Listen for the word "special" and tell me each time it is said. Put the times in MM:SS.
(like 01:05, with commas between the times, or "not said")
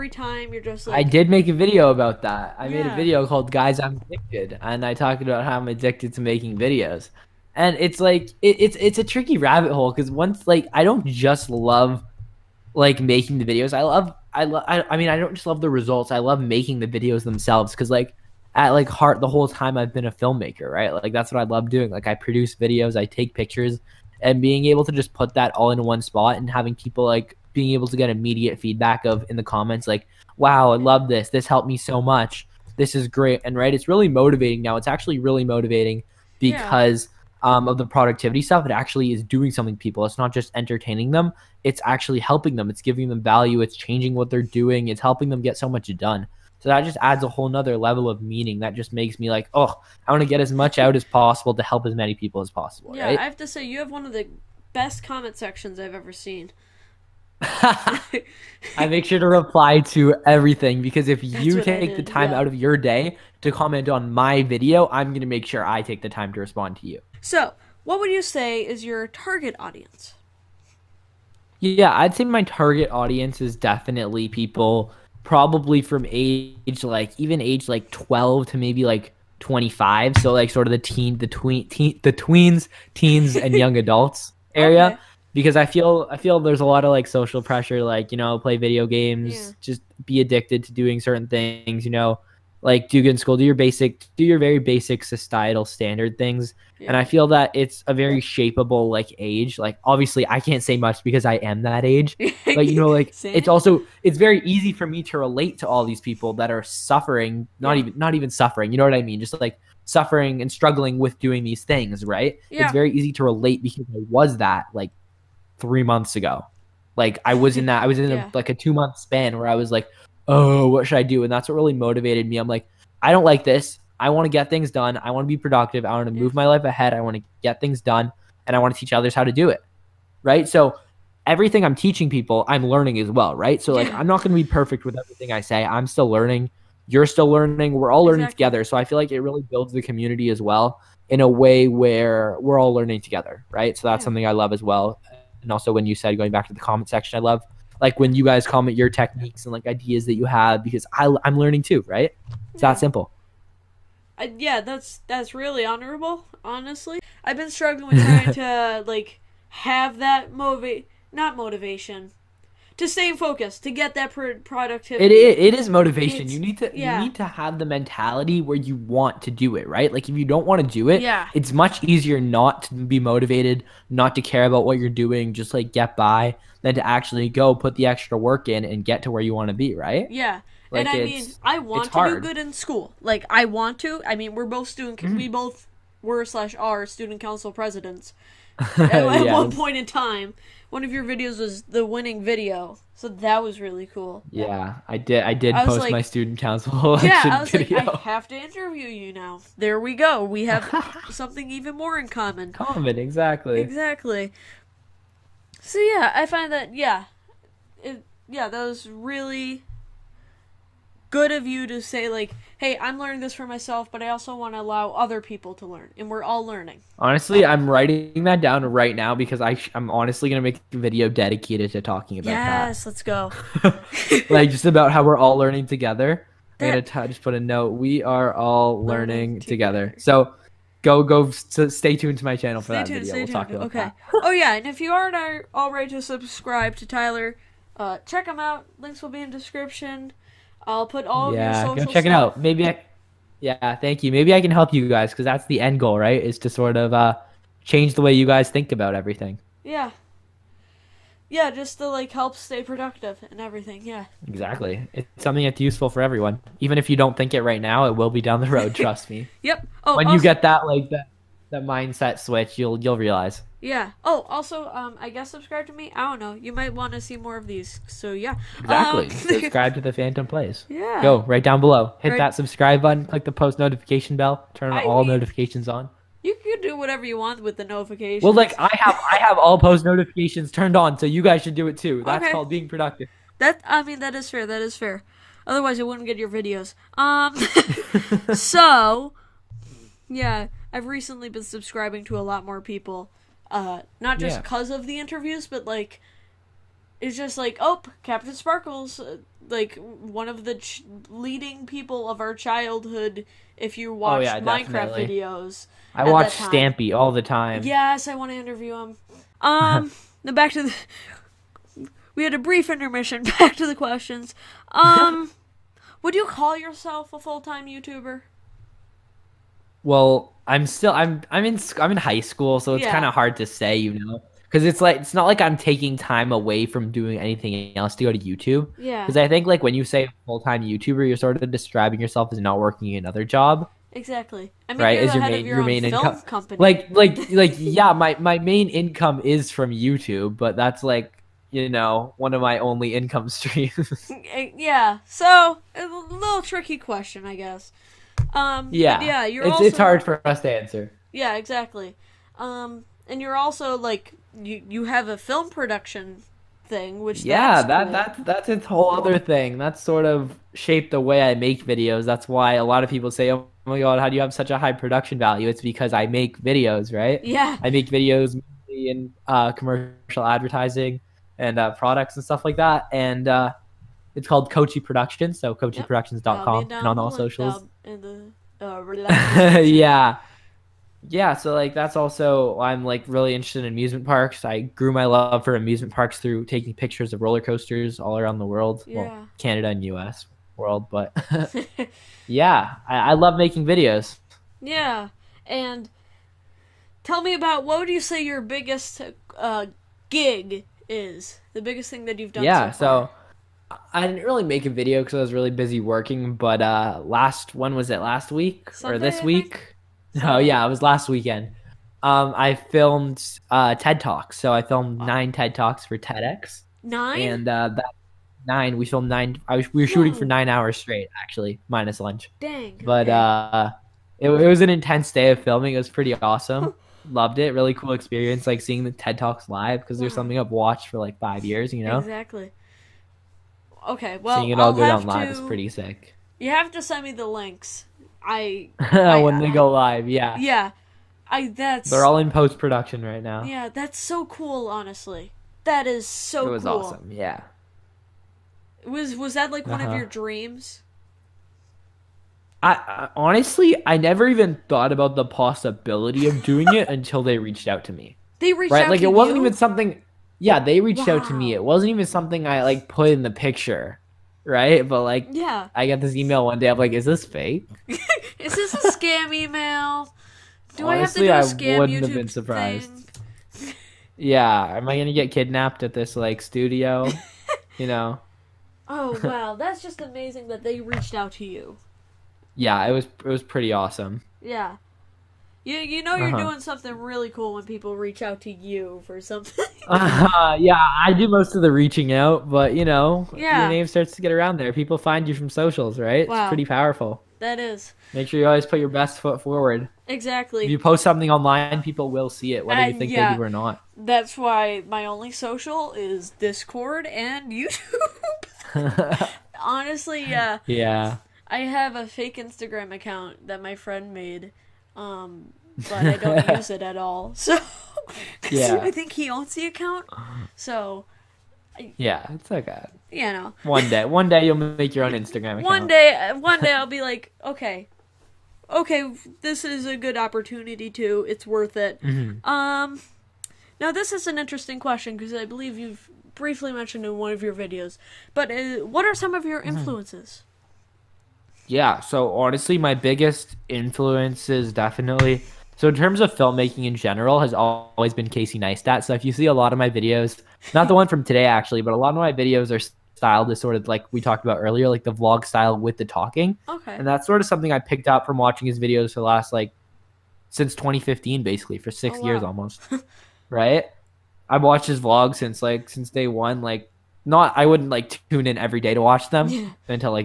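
not said.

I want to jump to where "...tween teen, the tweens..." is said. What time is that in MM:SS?
01:21.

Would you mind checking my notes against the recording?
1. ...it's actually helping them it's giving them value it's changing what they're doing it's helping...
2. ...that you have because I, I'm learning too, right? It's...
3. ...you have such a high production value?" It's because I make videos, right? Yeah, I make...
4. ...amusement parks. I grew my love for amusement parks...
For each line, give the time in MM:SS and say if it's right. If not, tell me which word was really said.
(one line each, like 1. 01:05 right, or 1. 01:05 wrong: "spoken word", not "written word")
1. 00:41 right
2. 02:30 right
3. 06:04 right
4. 06:23 right.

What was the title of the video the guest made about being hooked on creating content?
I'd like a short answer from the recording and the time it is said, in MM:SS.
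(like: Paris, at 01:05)
Guys, I'm Addicted, at 00:03.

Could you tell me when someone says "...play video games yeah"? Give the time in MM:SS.
01:28.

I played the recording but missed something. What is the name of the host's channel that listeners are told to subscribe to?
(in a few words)
The Phantom Plays.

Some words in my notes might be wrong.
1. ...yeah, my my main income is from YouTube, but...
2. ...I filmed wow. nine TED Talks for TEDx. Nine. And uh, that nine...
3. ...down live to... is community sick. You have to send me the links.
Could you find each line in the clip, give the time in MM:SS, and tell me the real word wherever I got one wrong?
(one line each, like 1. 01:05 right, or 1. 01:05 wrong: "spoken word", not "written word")
1. 05:37 right
2. 06:54 right
3. 07:14 wrong: "pretty", not "community".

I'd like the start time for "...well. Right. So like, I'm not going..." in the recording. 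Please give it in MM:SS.
02:13.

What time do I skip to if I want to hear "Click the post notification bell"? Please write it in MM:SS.
04:33.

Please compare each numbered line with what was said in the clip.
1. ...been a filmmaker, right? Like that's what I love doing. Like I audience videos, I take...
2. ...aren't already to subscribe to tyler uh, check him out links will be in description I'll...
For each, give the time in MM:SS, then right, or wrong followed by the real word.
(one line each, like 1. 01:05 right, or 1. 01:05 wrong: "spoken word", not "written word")
1. 00:19 wrong: "produce", not "audience"
2. 03:54 right.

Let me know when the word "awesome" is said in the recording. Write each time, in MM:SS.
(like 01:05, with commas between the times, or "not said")
07:06, 07:26, 08:03.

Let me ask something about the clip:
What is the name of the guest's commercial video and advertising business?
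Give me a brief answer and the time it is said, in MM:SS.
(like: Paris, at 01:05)
Cocci Productions, at 06:14.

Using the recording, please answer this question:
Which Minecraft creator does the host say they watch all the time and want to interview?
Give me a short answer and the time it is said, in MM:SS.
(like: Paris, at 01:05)
Stampy, at 05:06.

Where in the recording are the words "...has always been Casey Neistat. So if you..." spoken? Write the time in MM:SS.
09:07.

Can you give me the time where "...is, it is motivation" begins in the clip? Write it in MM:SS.
02:45.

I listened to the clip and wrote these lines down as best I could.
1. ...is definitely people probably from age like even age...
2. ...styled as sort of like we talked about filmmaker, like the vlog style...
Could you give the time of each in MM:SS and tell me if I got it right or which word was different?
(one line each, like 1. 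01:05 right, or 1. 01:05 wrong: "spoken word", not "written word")
1. 01:13 right
2. 09:13 wrong: "earlier", not "filmmaker".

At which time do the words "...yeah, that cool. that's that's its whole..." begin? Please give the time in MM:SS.
05:57.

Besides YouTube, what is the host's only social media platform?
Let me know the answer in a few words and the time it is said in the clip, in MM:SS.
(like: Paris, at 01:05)
Discord, at 08:26.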